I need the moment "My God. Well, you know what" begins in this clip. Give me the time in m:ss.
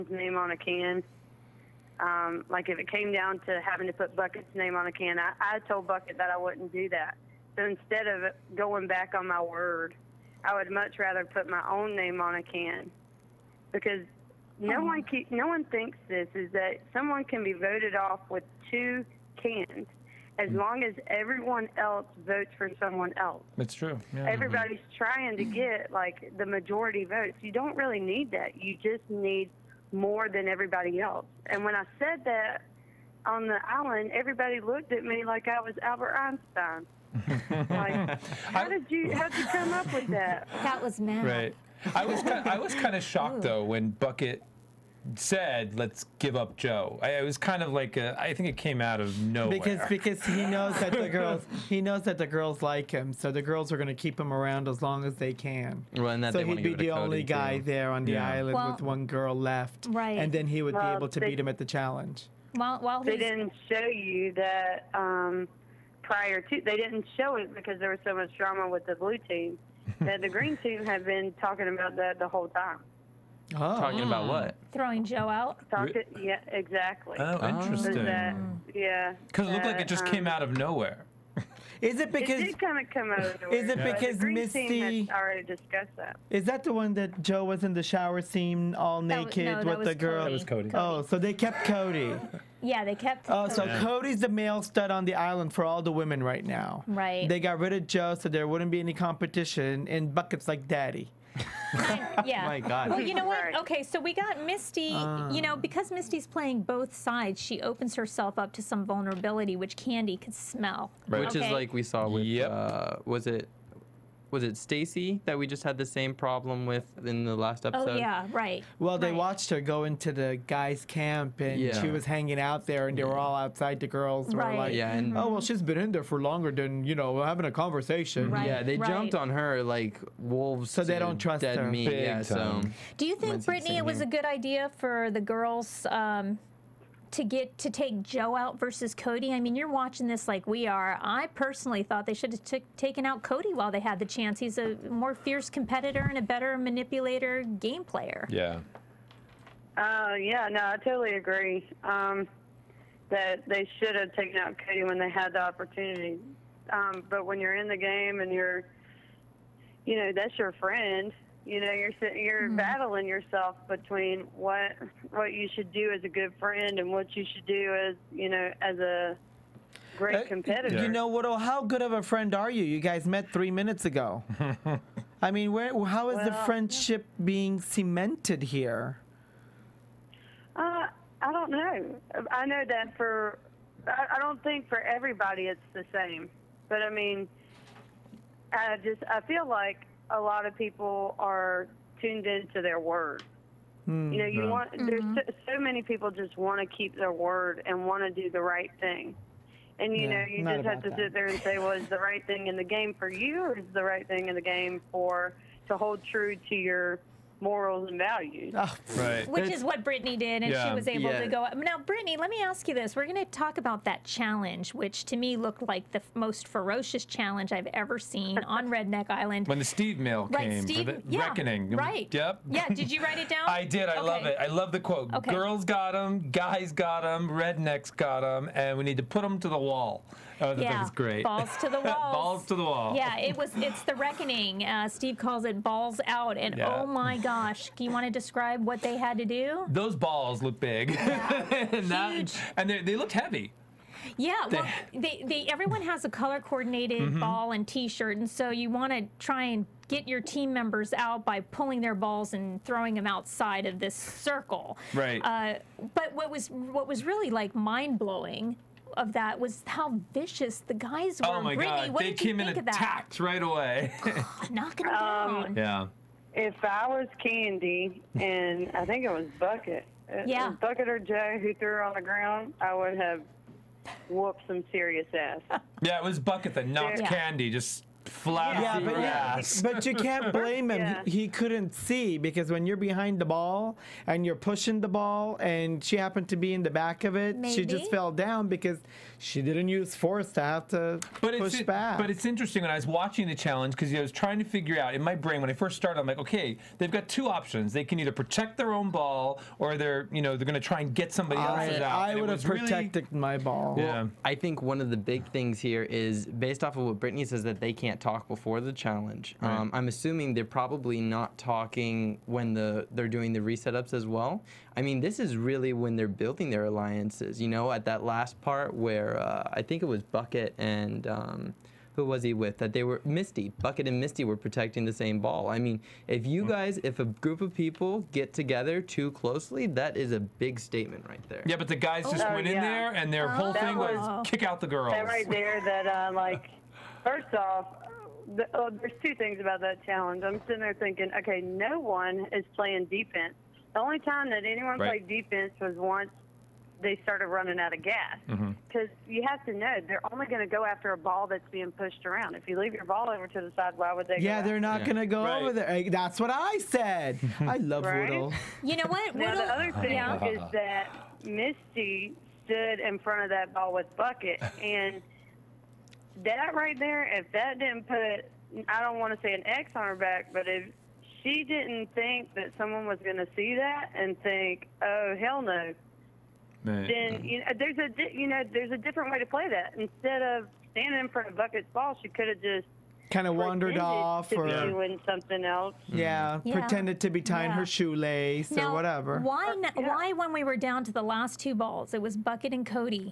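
1:42.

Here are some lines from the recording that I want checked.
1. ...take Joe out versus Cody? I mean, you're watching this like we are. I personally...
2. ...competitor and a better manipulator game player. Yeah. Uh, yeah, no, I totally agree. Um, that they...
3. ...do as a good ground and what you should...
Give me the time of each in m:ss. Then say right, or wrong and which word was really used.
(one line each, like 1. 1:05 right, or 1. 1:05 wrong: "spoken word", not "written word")
1. 2:17 right
2. 2:25 right
3. 2:45 wrong: "friend", not "ground".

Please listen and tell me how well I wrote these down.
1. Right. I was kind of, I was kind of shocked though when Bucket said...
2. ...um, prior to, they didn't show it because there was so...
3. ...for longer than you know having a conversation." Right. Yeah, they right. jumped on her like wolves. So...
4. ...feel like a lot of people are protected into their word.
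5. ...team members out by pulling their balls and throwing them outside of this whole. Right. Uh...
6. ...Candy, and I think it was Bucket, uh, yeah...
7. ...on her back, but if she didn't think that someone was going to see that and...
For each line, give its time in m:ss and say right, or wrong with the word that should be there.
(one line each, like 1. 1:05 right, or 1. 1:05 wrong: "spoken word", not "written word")
1. 0:41 right
2. 1:04 right
3. 2:06 right
4. 3:09 wrong: "tuned", not "protected"
5. 4:10 wrong: "circle", not "whole"
6. 4:27 right
7. 6:09 right.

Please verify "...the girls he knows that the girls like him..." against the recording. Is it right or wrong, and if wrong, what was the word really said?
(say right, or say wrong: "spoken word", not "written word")
right.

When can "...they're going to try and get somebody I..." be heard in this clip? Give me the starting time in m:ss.
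5:00.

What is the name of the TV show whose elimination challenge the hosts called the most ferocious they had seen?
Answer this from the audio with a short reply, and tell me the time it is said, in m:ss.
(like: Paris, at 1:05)
Redneck Island, at 3:38.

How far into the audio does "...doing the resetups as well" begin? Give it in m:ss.
5:13.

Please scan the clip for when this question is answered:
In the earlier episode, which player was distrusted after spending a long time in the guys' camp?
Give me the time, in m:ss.
1:54.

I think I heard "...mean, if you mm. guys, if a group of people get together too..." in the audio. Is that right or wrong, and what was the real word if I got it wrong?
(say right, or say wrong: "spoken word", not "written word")
right.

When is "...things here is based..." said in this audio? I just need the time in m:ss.
5:05.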